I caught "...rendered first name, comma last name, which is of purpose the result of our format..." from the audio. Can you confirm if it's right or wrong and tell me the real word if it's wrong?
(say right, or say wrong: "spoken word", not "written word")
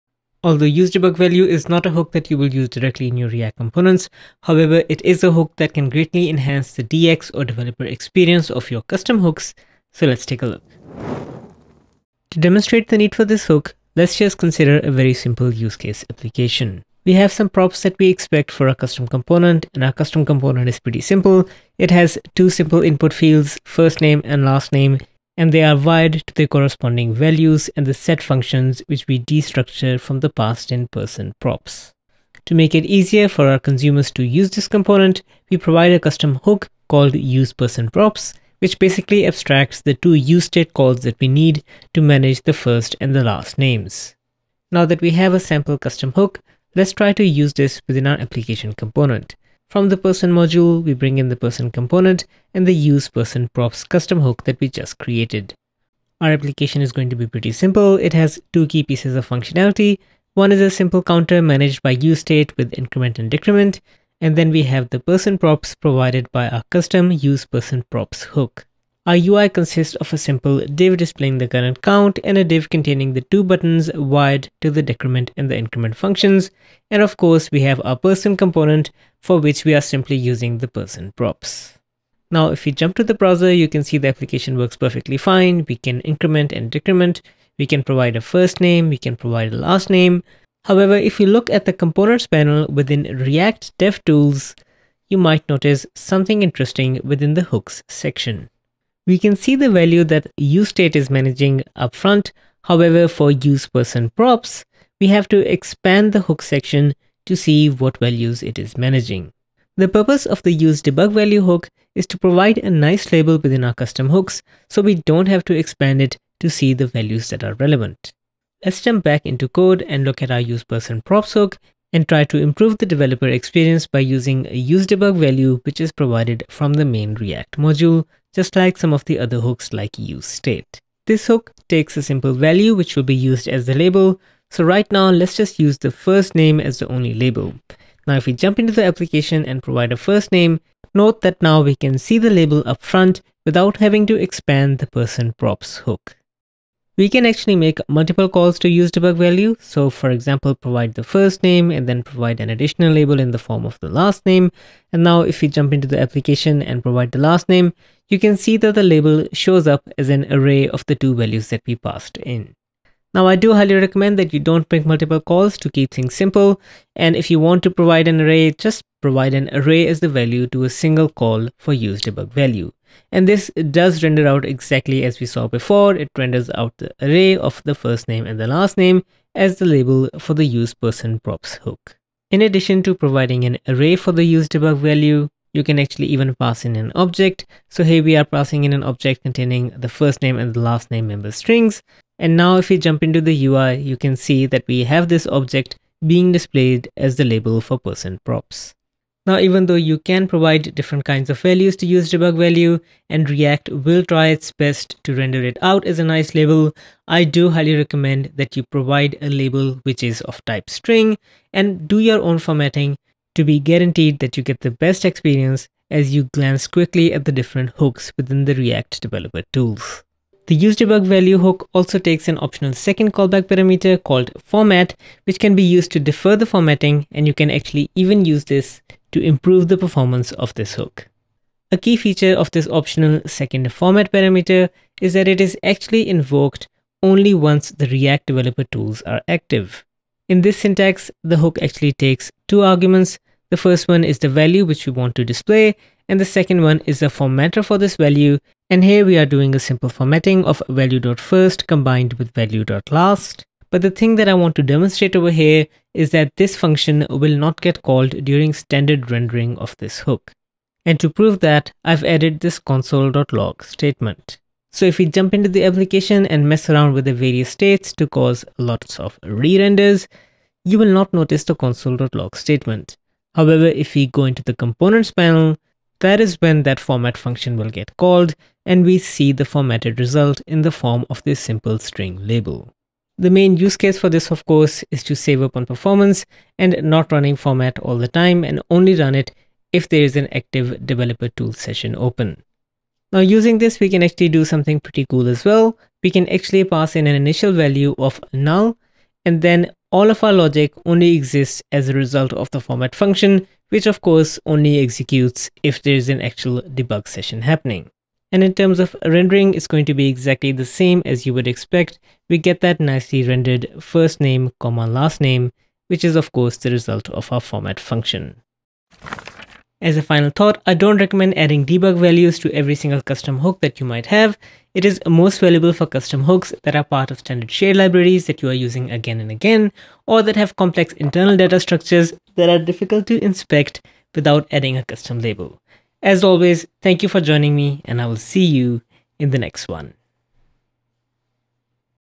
wrong: "course", not "purpose".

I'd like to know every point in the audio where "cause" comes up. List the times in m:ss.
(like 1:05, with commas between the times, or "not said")
4:28.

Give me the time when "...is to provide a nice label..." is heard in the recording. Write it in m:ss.
1:51.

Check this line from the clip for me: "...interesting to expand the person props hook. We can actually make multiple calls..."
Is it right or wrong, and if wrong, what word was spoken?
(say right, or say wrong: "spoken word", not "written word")
wrong: "having", not "interesting".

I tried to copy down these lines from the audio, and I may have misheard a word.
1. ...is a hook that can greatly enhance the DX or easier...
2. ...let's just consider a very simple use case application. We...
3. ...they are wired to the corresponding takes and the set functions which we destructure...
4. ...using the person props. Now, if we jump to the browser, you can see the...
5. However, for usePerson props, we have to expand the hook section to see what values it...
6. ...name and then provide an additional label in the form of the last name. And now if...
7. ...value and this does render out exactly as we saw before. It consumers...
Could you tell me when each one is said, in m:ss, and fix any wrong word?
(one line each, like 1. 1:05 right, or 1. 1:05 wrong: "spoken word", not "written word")
1. 0:05 wrong: "developer", not "easier"
2. 0:13 right
3. 0:25 wrong: "values", not "takes"
4. 1:20 right
5. 1:42 right
6. 2:31 right
7. 2:52 wrong: "renders", not "consumers".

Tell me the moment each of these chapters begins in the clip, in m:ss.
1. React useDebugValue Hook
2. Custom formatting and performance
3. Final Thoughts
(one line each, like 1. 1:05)
1. 0:11
2. 3:40
3. 5:19.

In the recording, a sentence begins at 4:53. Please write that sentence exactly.
Now using this we can actually do something pretty cool as well.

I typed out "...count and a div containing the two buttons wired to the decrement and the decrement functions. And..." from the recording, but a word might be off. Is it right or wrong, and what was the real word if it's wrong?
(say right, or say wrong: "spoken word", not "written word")
wrong: "increment", not "decrement".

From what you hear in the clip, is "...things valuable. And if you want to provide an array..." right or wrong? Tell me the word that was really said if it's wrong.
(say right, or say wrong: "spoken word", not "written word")
wrong: "simple", not "valuable".